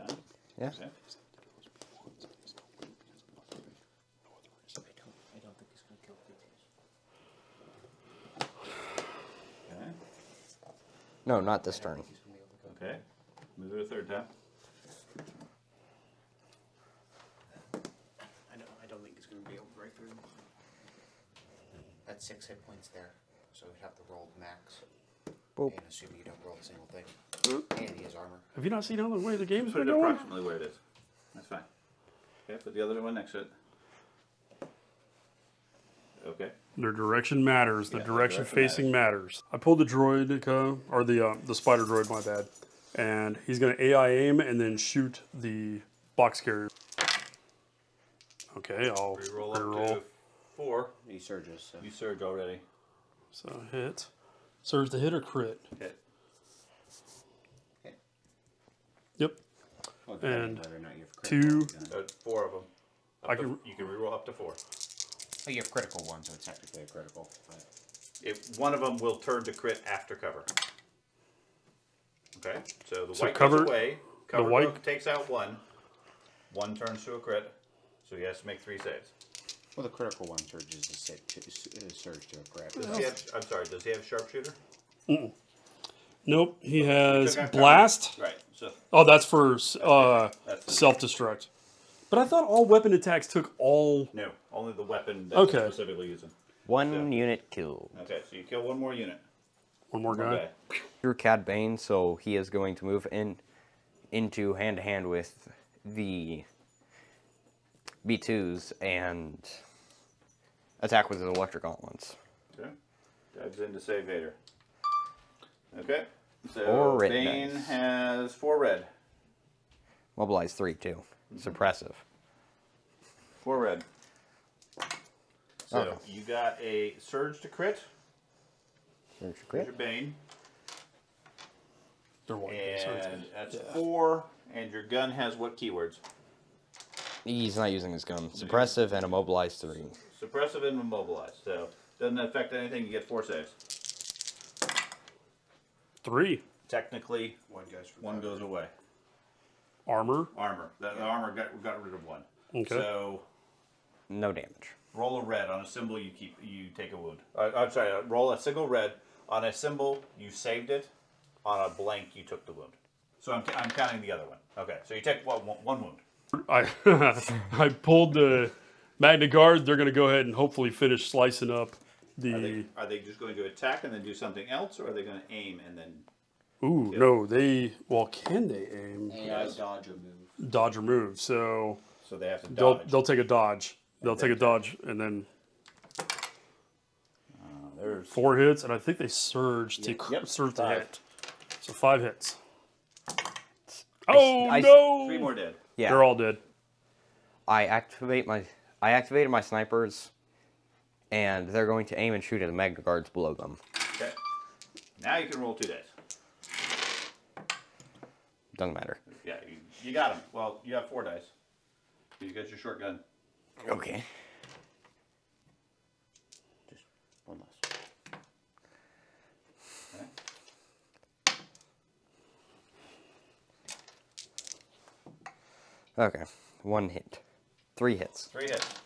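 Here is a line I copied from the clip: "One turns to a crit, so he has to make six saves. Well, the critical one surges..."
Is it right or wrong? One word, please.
wrong.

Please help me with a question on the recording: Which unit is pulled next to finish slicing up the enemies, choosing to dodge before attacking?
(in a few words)
Magna Guard.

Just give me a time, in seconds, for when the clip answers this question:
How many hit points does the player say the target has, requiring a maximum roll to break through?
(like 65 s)
22 s.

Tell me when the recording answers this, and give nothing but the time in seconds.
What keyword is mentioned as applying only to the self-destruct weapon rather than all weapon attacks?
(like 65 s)
87 s.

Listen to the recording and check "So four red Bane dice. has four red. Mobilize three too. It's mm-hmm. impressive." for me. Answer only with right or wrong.
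right.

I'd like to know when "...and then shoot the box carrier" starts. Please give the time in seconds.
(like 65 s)
44 s.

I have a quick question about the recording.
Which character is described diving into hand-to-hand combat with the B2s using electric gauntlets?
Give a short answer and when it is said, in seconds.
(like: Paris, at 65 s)
Cad Bane, at 101 s.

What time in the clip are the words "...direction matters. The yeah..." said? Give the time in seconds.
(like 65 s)
36 s.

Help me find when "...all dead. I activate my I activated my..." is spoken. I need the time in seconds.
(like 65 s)
196 s.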